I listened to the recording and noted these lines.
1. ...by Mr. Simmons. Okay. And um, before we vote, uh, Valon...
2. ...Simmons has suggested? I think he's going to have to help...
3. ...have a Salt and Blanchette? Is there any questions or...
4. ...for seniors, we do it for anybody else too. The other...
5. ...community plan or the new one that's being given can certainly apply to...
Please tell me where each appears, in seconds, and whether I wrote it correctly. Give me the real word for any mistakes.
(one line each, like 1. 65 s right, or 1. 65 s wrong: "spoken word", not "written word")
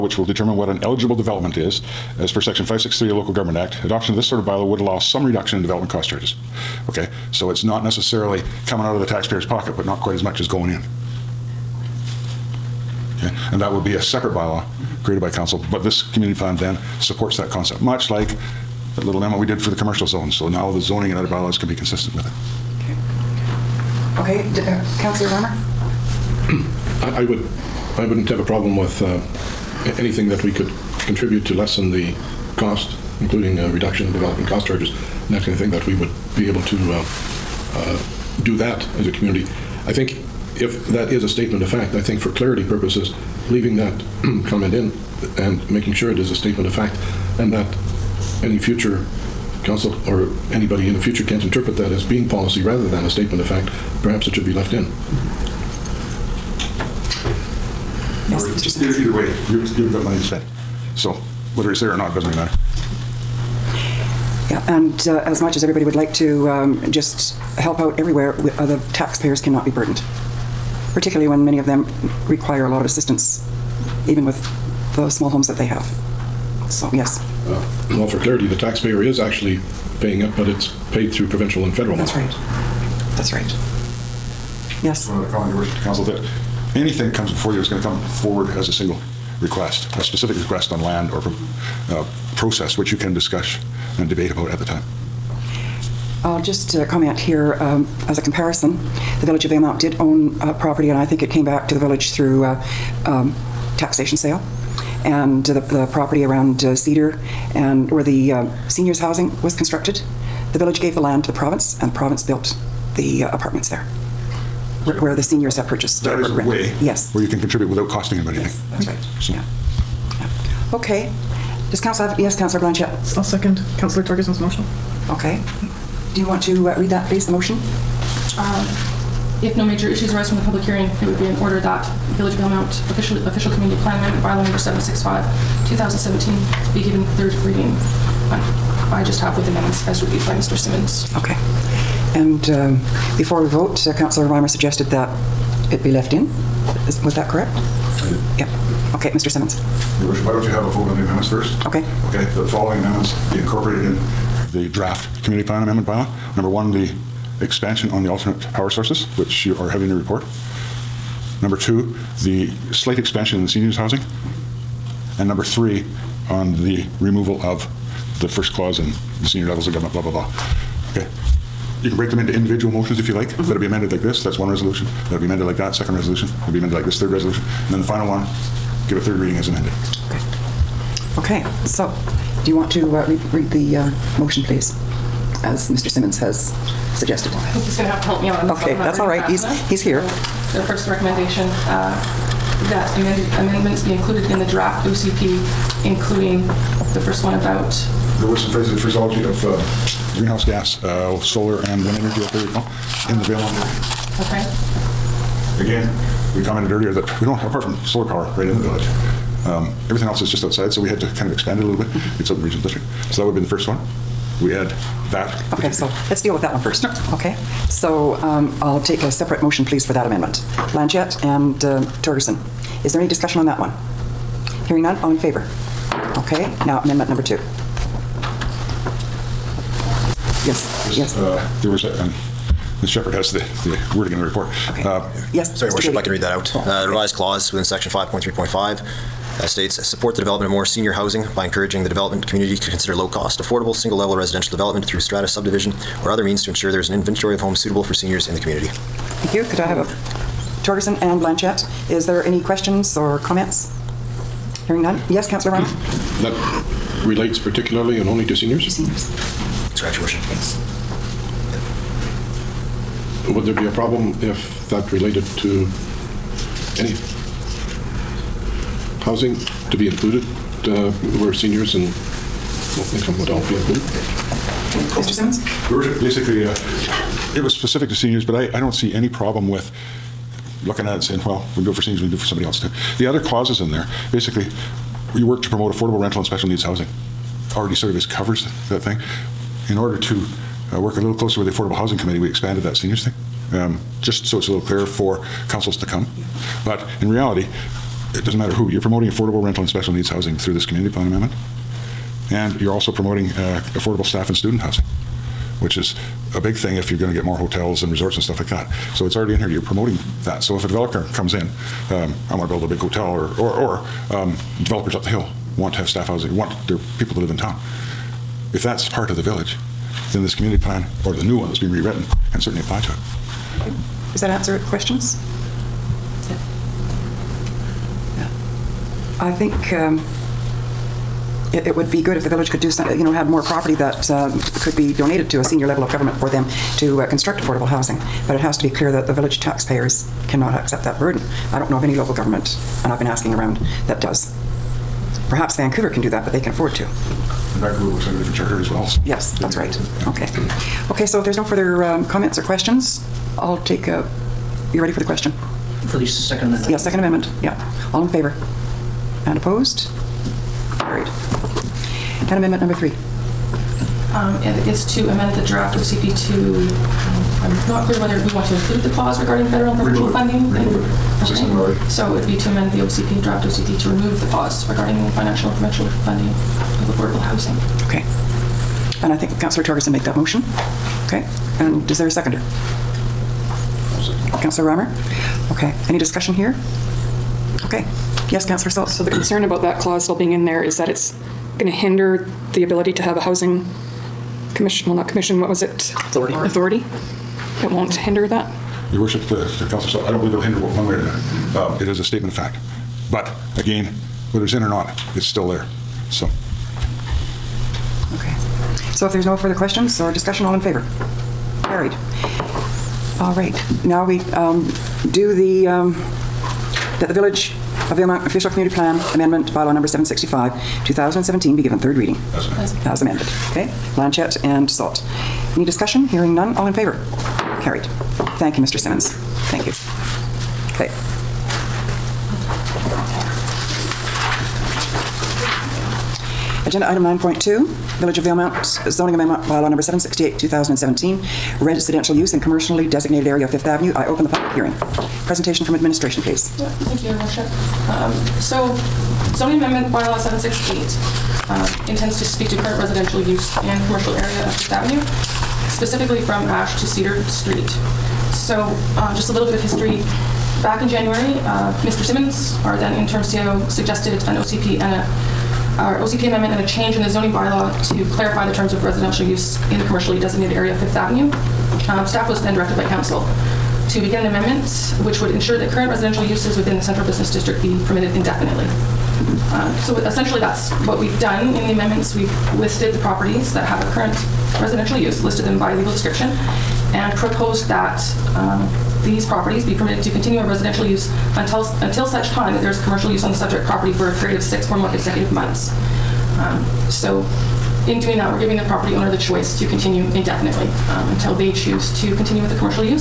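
1. 140 s wrong: "Councillor", not "Valon"
2. 185 s right
3. 249 s wrong: "Torgerson", not "Salt"
4. 281 s wrong: "somebody", not "anybody"
5. 320 s wrong: "rewritten", not "given".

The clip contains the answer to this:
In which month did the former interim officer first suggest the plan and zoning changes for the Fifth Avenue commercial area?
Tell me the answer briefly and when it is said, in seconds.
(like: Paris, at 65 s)
January, at 460 s.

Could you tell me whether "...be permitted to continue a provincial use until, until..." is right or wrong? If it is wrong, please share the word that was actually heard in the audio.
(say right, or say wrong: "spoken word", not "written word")
wrong: "residential", not "provincial".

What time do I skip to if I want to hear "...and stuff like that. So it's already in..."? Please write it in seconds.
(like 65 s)
308 s.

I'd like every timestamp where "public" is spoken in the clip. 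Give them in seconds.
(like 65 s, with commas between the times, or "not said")
130 s, 444 s.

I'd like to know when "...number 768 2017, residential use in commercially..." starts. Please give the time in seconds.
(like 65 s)
439 s.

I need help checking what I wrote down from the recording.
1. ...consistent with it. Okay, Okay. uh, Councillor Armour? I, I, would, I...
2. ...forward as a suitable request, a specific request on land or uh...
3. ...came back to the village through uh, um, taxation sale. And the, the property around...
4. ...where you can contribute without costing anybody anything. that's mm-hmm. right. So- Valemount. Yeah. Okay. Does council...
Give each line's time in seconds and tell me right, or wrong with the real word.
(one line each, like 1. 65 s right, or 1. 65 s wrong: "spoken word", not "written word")
1. 21 s right
2. 88 s wrong: "single", not "suitable"
3. 101 s right
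4. 117 s wrong: "Yeah", not "Valemount".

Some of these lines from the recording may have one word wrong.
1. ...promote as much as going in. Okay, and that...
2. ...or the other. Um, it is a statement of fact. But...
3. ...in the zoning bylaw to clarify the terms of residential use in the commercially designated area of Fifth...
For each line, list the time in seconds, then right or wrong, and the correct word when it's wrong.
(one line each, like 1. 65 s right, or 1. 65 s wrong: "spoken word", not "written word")
1. 10 s wrong: "quite", not "promote"
2. 400 s right
3. 466 s right.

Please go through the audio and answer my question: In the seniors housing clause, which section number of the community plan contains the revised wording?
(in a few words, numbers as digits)
5.3.5.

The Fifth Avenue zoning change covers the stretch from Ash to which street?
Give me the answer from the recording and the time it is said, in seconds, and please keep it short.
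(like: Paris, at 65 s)
Cedar Street, at 456 s.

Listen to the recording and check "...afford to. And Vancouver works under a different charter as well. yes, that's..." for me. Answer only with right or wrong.
right.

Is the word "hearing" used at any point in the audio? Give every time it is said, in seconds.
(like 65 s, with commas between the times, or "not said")
130 s, 224 s, 254 s, 426 s, 444 s.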